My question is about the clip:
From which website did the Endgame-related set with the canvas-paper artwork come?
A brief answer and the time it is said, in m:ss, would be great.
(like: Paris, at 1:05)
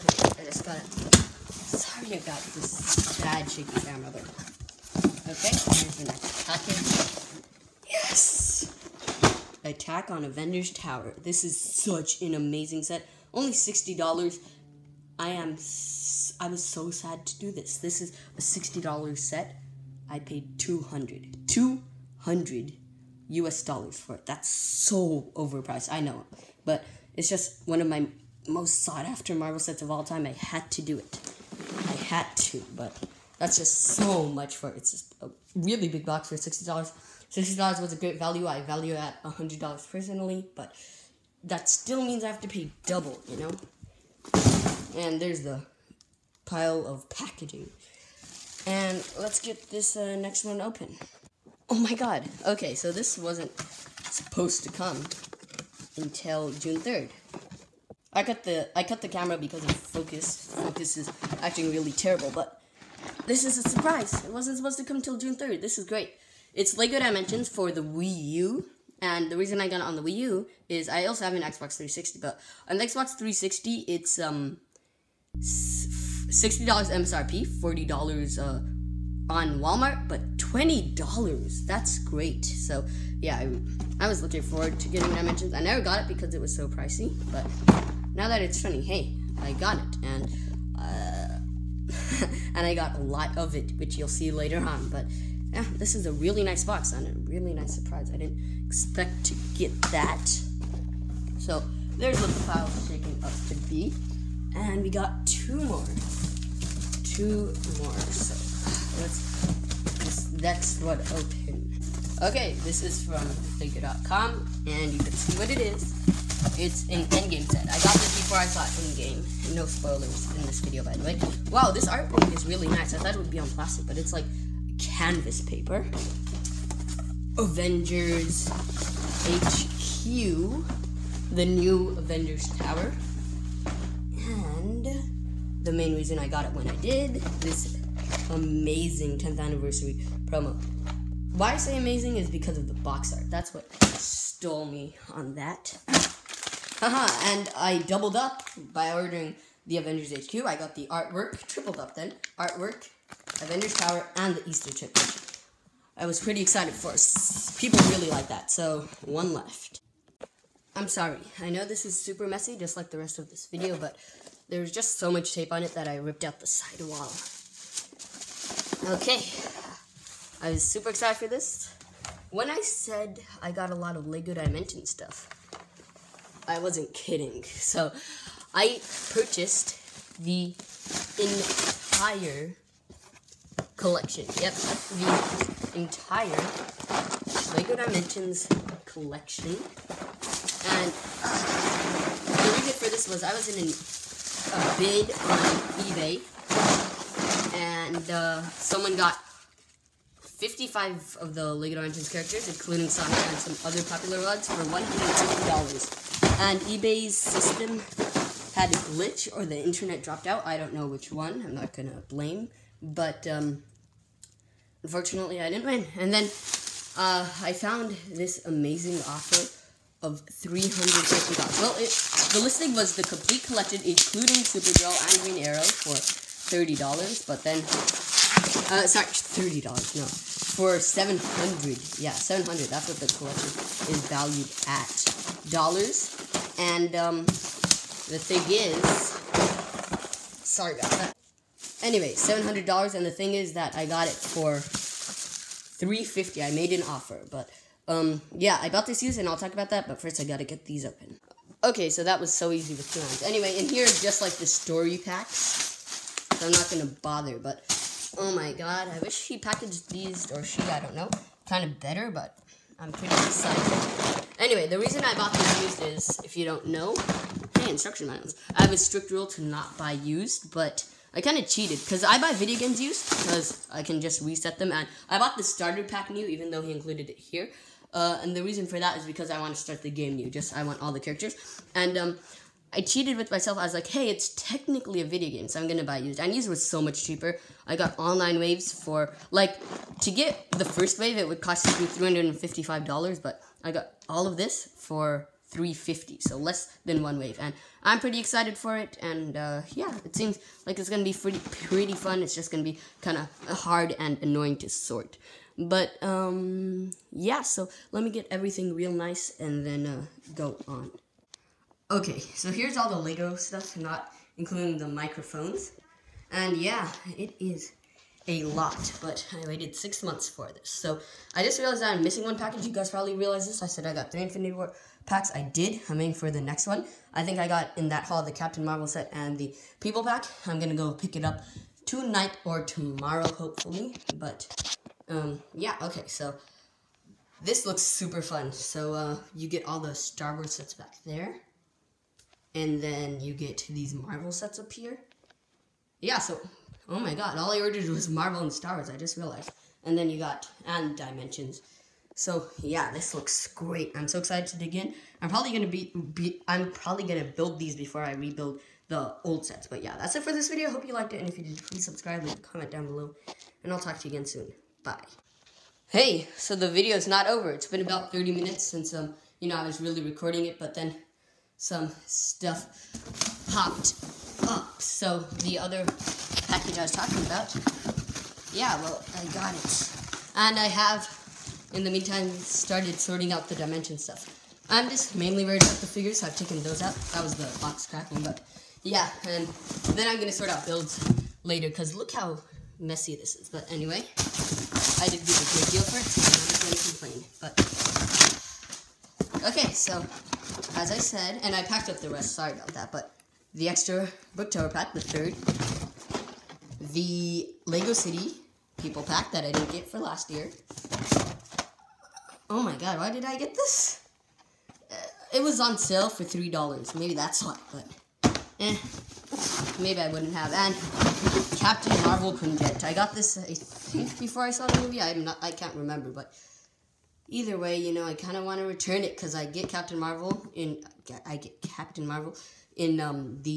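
figure.com, at 1:53.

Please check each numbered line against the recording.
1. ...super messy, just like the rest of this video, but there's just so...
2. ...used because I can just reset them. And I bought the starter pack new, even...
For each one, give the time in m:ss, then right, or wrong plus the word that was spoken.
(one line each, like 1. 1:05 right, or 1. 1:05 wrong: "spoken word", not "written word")
1. 2:41 right
2. 4:32 right.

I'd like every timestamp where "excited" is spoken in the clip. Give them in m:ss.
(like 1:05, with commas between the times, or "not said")
2:36, 2:50, 4:23, 4:58, 5:54.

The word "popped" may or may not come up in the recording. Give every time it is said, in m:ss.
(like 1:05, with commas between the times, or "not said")
6:13.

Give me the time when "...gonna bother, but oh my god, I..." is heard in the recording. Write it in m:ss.
4:16.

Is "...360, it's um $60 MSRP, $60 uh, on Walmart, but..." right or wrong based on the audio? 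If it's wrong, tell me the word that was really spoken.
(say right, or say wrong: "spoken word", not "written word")
wrong: "40", not "60".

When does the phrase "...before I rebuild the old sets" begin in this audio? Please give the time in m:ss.
5:57.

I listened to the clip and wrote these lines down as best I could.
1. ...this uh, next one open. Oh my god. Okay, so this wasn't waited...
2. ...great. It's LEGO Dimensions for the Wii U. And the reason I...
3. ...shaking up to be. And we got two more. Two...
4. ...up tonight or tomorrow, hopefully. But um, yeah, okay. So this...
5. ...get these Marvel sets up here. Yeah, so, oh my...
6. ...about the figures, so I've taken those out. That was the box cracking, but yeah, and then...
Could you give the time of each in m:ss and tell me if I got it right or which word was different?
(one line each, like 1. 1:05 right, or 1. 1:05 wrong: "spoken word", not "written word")
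1. 0:49 wrong: "supposed", not "waited"
2. 1:05 right
3. 1:42 right
4. 5:31 right
5. 5:43 right
6. 6:25 right.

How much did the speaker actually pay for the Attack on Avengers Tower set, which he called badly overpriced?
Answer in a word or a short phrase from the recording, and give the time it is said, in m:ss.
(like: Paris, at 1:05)
$200, at 0:20.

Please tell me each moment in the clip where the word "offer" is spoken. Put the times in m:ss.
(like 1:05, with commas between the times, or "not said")
3:39, 4:06.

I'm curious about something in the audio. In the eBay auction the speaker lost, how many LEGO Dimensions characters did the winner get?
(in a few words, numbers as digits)
55.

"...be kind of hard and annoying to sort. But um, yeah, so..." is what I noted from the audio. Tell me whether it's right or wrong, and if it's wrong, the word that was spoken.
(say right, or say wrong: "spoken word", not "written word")
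right.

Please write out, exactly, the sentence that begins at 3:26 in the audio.
And eBay's system had a glitch or the internet dropped out.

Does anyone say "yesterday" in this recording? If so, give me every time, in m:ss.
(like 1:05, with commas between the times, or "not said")
not said.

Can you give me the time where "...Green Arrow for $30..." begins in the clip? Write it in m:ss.
3:45.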